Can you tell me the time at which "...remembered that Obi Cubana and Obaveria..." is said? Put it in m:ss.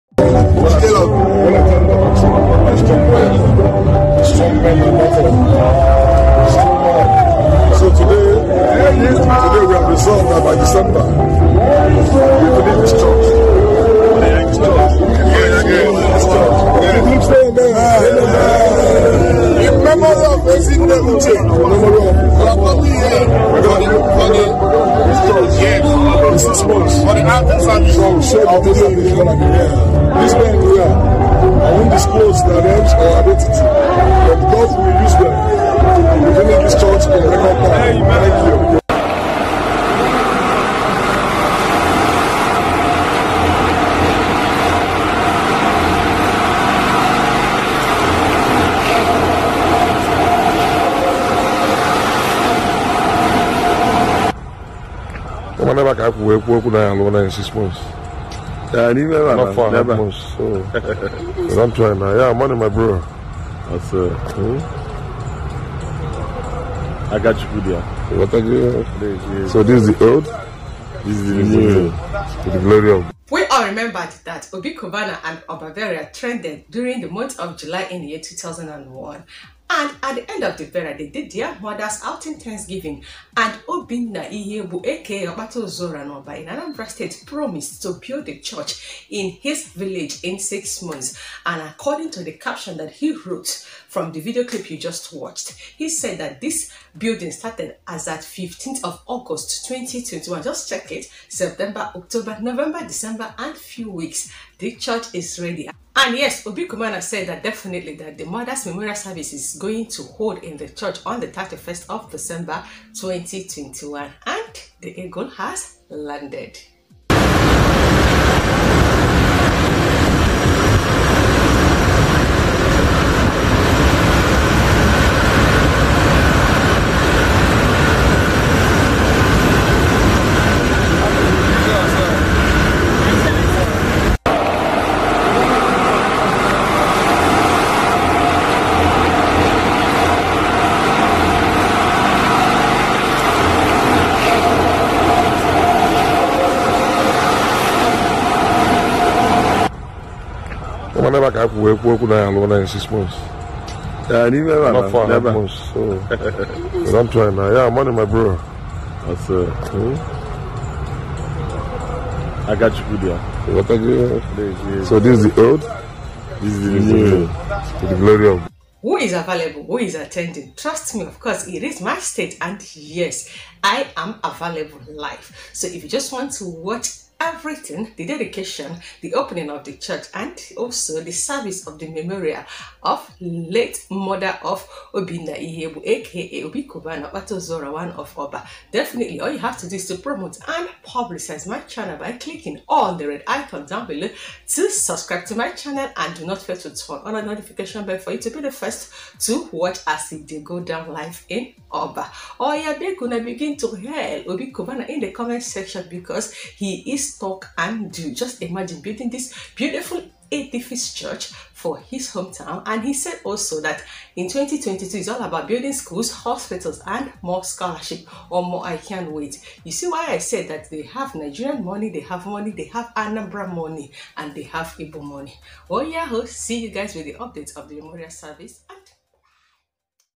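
1:13.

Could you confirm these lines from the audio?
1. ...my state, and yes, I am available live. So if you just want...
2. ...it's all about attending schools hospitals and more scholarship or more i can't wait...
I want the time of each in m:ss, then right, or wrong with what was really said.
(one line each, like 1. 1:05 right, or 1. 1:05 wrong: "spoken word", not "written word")
1. 2:51 right
2. 3:34 wrong: "building", not "attending".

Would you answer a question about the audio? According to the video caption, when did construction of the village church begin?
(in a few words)
15 August 2021.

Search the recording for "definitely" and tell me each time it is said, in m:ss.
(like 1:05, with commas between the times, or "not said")
1:47, 3:08.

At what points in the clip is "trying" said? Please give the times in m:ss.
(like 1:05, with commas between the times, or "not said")
1:01, 2:37.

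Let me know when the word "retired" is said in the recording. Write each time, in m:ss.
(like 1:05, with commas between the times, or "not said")
not said.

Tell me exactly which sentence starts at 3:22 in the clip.
Oh yeah, are gonna begin to hail Obi Cubana in the comment section because he is talk and do.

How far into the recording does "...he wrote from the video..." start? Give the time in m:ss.
1:32.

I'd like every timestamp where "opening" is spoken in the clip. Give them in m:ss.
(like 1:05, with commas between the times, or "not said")
2:59.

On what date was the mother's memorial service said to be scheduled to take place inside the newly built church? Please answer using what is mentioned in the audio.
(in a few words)
31 December 2021.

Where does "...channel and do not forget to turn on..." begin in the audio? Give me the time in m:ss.
3:15.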